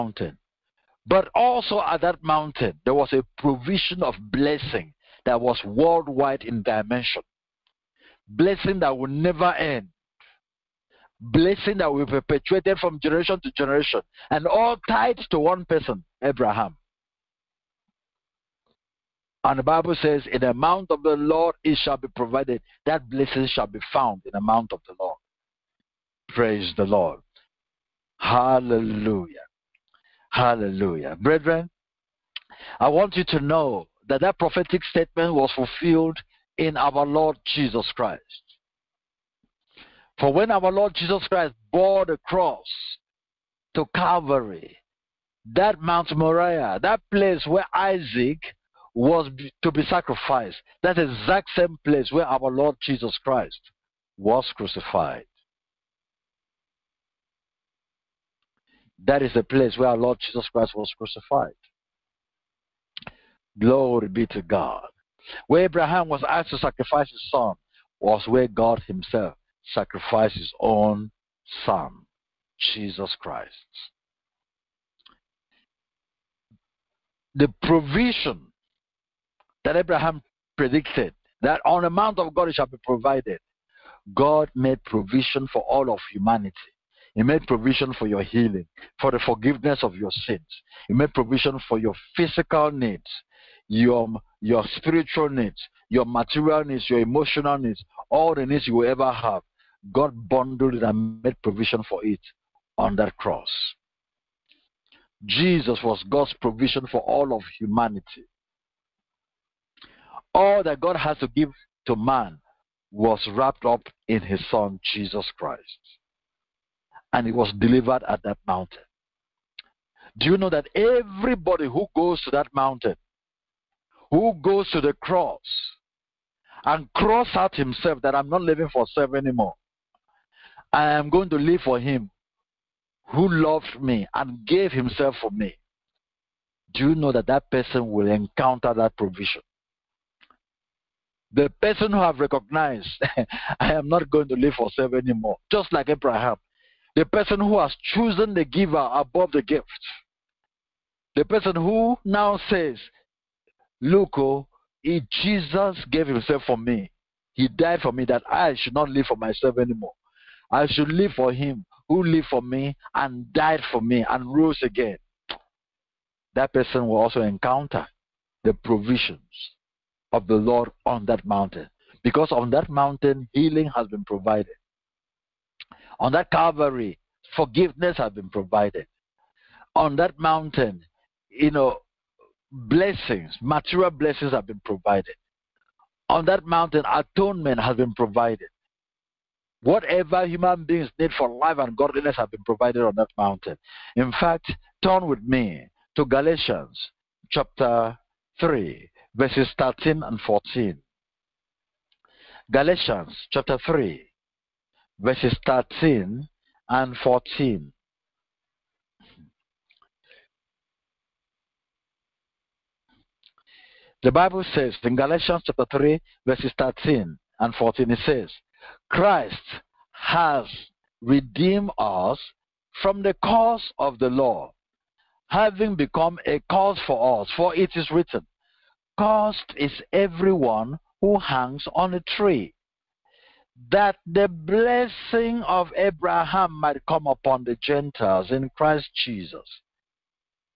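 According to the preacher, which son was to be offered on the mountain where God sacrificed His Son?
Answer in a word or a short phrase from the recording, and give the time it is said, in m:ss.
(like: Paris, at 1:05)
Isaac, at 0:47.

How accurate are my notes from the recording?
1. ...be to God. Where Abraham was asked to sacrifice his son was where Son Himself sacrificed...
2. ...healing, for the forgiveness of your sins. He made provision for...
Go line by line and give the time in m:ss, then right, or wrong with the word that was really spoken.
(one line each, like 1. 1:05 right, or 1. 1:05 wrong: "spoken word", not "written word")
1. 1:04 wrong: "God", not "Son"
2. 1:28 right.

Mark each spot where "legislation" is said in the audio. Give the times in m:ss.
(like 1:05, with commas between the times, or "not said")
not said.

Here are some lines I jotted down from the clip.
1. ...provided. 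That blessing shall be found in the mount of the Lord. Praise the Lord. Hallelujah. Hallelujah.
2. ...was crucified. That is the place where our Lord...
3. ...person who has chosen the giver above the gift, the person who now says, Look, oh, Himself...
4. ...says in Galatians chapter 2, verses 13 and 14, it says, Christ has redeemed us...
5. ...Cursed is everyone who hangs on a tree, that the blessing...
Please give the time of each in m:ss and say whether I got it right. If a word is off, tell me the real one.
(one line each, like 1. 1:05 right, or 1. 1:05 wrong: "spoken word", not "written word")
1. 0:22 right
2. 0:54 right
3. 2:27 wrong: "Jesus", not "Himself"
4. 3:34 wrong: "3", not "2"
5. 3:48 right.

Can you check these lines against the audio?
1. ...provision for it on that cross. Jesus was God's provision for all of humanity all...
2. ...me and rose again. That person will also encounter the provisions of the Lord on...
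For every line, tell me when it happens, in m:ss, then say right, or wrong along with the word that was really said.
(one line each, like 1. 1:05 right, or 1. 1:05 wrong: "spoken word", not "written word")
1. 1:41 right
2. 2:43 right.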